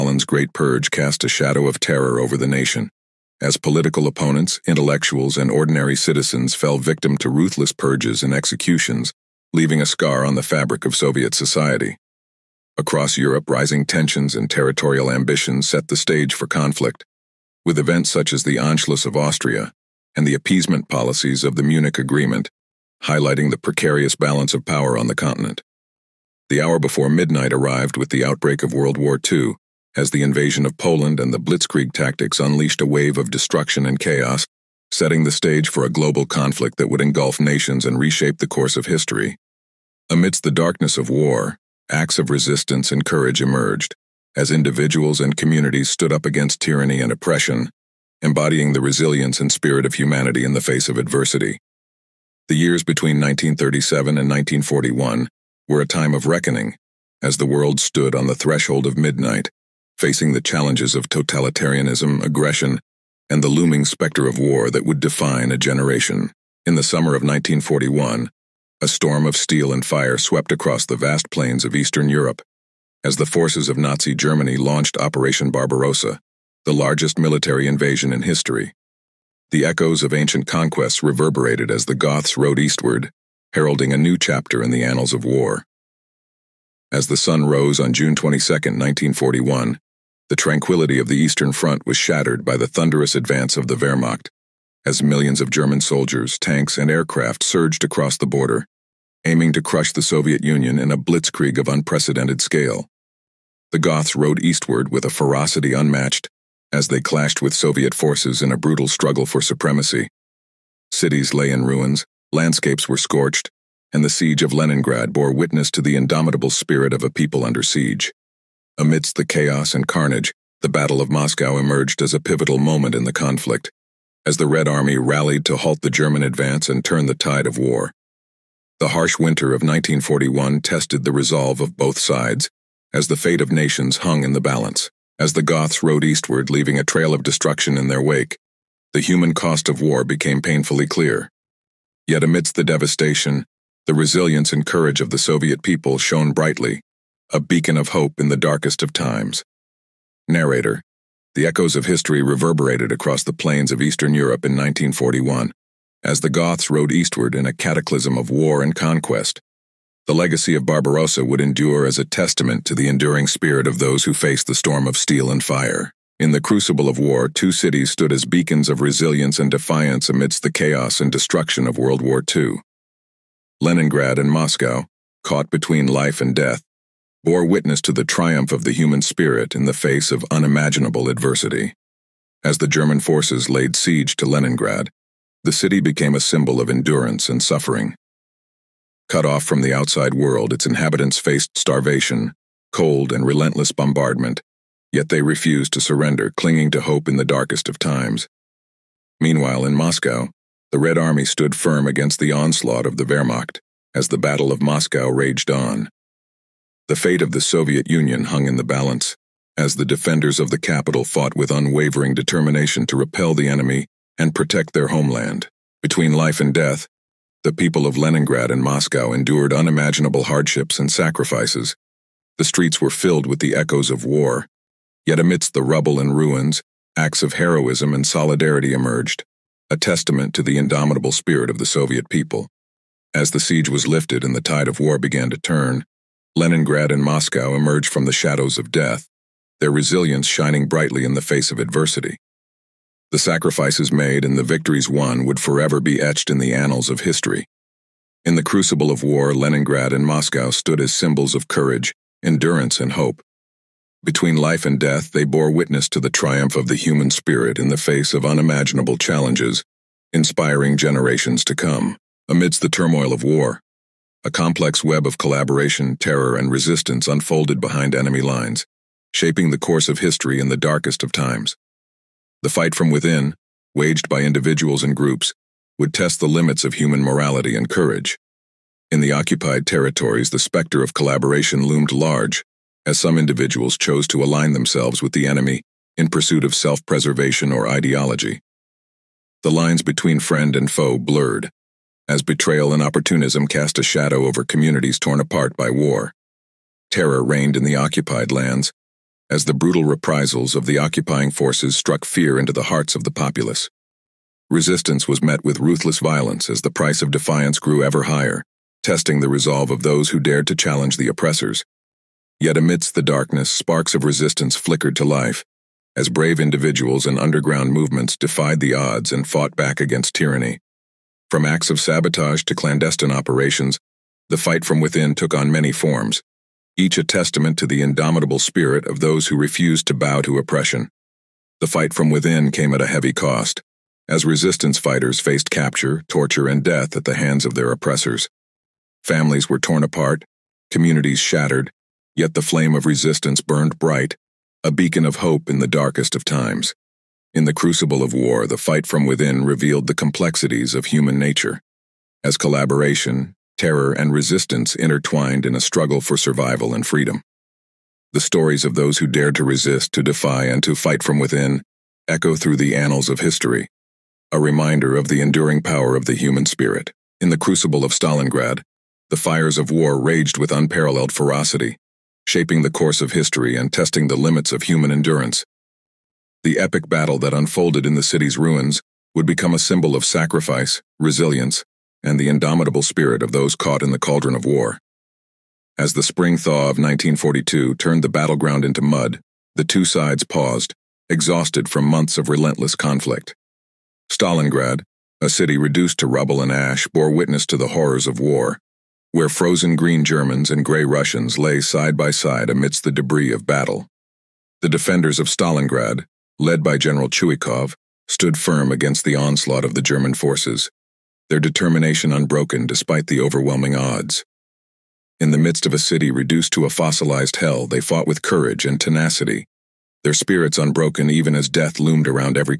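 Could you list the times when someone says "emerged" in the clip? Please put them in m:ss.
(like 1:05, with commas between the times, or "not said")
0:43, 2:01, 3:48, 3:57.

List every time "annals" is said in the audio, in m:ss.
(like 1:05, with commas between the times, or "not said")
1:24, 4:06, 6:02.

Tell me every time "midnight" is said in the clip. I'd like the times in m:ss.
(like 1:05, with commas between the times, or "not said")
0:27, 0:58.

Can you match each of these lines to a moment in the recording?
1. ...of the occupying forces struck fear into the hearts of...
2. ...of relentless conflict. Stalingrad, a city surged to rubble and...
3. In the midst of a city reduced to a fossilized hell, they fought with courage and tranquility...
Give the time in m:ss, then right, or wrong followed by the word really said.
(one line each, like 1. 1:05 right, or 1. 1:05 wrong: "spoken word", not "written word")
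1. 5:00 right
2. 6:32 wrong: "reduced", not "surged"
3. 6:55 wrong: "tenacity", not "tranquility".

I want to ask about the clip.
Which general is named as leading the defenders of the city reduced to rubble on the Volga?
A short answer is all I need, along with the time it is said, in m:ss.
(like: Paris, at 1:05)
General Chuikov, at 6:46.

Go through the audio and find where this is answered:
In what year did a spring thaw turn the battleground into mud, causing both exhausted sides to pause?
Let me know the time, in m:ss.
6:26.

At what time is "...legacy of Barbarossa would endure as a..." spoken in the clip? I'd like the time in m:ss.
2:40.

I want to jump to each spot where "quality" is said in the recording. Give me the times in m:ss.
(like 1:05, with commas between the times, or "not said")
not said.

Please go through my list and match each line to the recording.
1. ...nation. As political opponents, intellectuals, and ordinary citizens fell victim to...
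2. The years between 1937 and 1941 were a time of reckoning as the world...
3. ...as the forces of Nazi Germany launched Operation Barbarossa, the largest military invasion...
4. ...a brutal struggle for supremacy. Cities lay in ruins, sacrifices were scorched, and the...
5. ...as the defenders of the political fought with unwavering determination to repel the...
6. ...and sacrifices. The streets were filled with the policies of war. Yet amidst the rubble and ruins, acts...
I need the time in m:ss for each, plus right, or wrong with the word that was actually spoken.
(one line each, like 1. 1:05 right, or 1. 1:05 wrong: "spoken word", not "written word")
1. 0:02 right
2. 0:52 right
3. 1:13 right
4. 1:48 wrong: "landscapes", not "sacrifices"
5. 3:29 wrong: "capital", not "political"
6. 3:40 wrong: "echoes", not "policies".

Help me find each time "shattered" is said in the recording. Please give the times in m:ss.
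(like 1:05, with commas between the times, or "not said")
1:31, 5:41.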